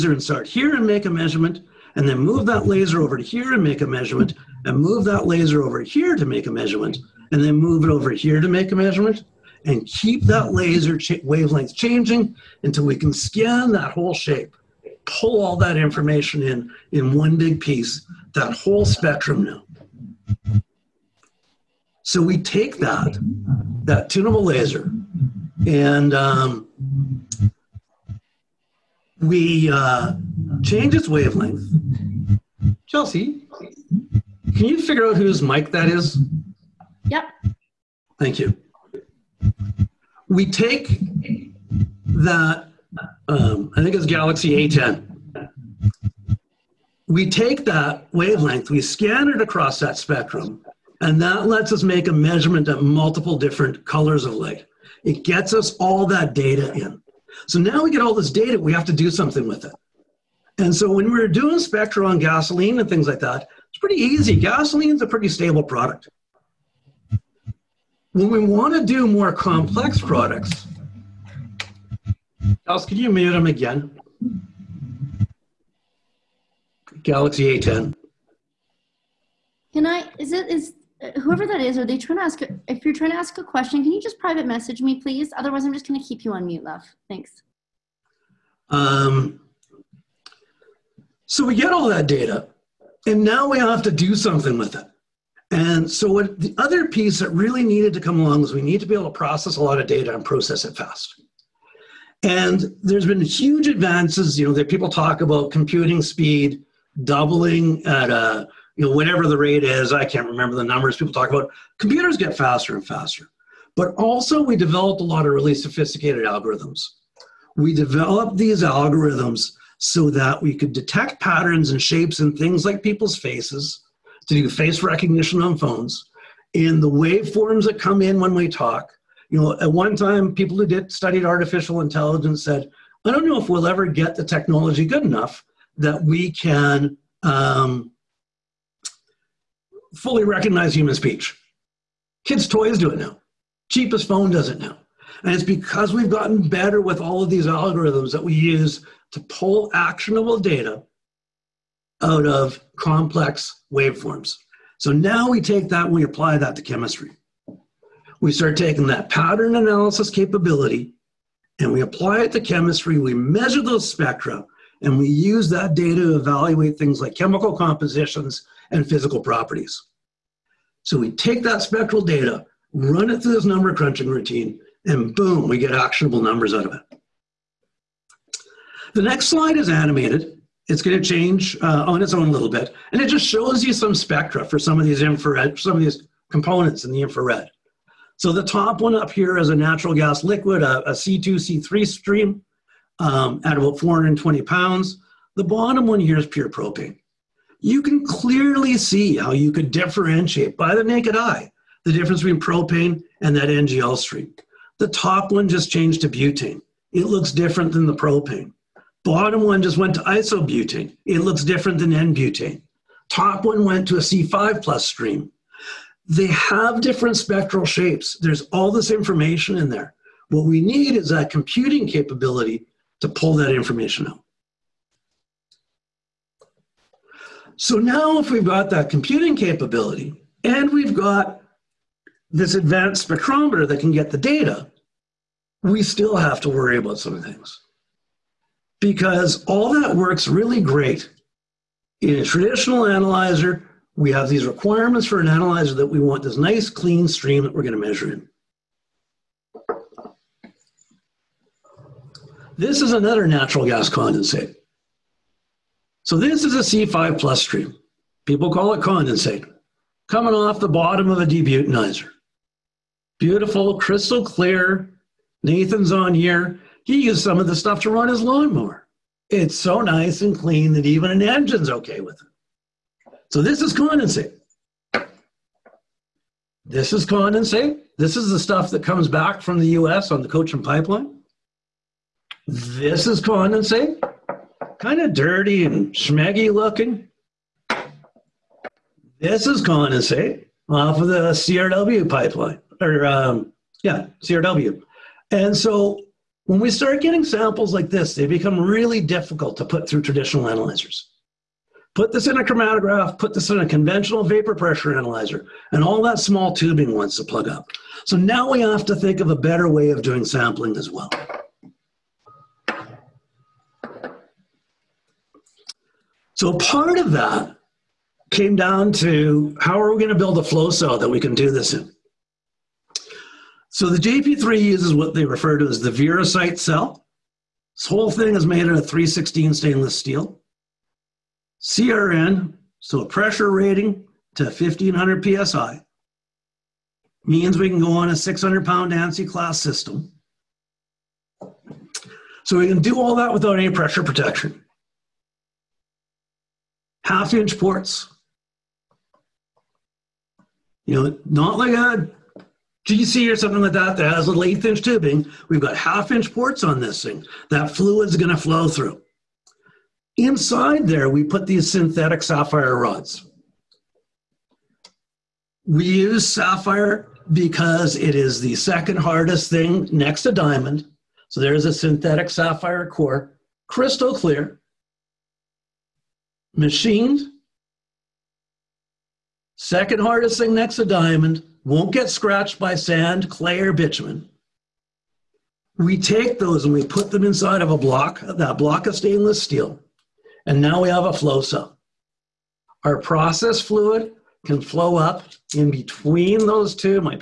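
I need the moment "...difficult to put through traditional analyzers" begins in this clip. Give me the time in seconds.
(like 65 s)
299 s.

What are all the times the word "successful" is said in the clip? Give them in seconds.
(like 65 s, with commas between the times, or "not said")
not said.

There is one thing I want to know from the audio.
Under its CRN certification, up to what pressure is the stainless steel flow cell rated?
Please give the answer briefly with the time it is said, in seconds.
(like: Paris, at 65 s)
1500 psi, at 334 s.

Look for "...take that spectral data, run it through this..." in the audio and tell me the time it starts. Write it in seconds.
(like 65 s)
171 s.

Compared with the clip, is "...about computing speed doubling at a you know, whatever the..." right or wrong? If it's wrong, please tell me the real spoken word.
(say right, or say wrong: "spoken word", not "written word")
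right.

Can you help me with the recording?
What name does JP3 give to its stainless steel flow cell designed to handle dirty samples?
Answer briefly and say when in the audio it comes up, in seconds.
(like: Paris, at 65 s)
Verosite cell, at 325 s.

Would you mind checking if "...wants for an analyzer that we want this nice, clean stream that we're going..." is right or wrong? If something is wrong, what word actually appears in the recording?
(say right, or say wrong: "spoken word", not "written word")
wrong: "requirements", not "wants".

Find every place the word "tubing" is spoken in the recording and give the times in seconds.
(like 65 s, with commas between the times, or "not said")
306 s, 354 s.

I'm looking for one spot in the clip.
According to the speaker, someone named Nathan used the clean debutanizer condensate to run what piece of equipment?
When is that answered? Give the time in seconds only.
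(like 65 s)
268 s.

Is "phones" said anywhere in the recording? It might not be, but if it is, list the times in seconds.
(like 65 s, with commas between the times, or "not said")
125 s, 144 s.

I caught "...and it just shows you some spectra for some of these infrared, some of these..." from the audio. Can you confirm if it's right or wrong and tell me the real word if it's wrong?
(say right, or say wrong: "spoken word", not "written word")
right.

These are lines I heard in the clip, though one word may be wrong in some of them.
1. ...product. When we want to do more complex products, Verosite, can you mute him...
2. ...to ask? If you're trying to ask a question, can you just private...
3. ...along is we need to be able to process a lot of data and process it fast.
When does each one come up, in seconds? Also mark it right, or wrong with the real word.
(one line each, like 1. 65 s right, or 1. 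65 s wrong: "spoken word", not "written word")
1. 65 s wrong: "Alice", not "Verosite"
2. 82 s right
3. 98 s right.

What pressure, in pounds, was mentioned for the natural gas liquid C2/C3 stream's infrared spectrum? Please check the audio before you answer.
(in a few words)
420.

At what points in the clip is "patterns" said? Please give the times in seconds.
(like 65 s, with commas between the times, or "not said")
121 s, 159 s.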